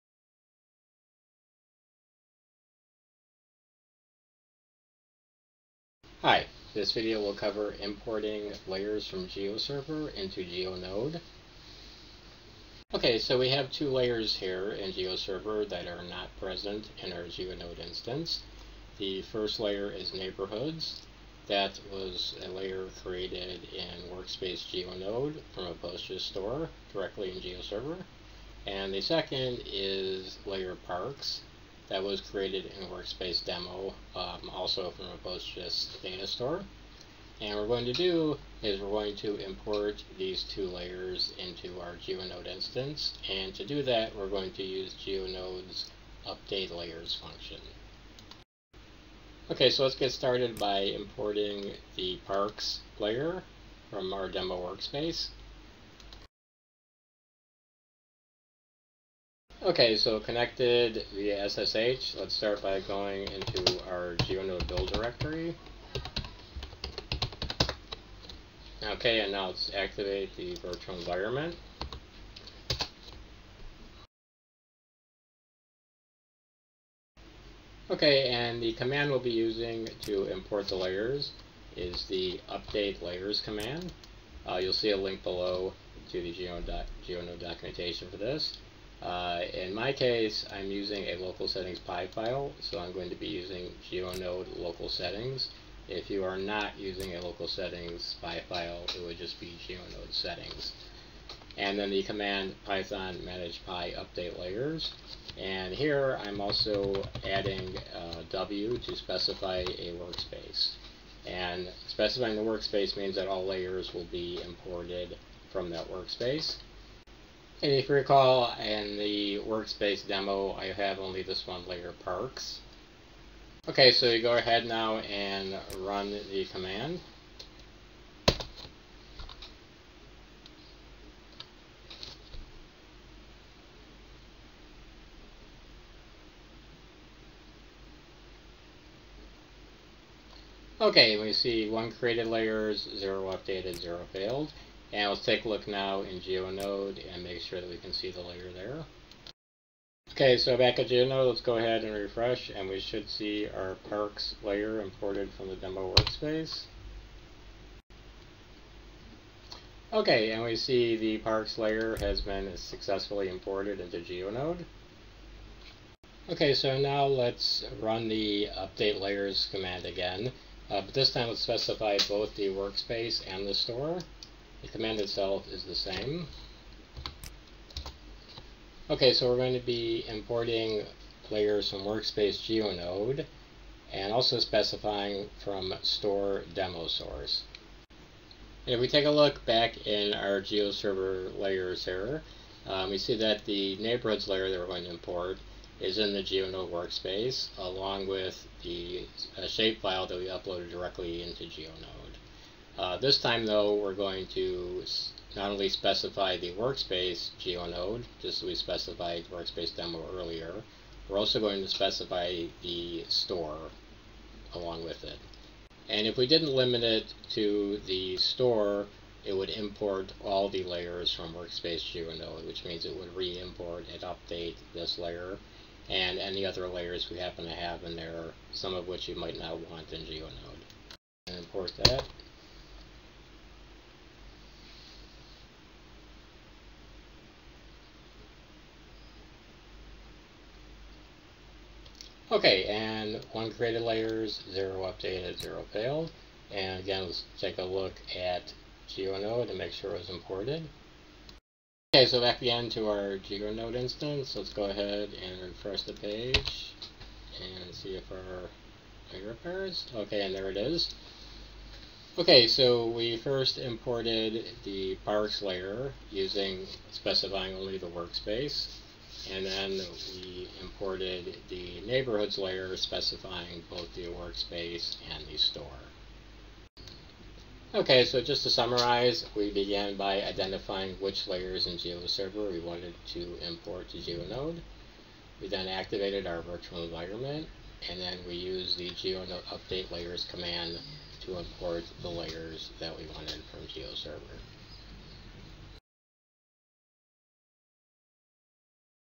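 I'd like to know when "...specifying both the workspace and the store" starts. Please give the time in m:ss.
4:32.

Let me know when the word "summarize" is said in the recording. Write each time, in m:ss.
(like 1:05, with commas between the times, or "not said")
4:38.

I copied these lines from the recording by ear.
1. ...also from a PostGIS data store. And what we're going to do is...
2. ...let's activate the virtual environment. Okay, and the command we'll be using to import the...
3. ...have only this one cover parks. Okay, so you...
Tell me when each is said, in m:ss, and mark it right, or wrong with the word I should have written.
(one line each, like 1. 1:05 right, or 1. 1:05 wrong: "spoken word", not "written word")
1. 0:34 right
2. 1:09 right
3. 2:00 wrong: "layer", not "cover".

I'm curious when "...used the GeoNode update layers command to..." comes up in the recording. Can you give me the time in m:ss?
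4:48.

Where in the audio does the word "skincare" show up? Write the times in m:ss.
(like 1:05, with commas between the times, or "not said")
not said.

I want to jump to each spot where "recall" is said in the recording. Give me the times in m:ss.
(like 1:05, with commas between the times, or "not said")
1:57.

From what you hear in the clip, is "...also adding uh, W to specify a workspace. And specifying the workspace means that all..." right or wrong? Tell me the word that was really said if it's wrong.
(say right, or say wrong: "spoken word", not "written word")
right.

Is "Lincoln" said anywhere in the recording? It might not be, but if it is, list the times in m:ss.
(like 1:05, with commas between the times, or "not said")
not said.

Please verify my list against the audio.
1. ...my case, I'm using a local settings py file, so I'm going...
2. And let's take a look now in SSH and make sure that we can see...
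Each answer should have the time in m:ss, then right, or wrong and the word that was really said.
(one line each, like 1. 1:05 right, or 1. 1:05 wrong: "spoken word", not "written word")
1. 1:29 right
2. 2:24 wrong: "GeoNode", not "SSH".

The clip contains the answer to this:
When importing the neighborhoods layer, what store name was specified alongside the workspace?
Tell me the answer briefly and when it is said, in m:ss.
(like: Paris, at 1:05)
demo source, at 3:06.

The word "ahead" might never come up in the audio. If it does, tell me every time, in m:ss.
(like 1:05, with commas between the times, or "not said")
2:04, 2:31, 4:14.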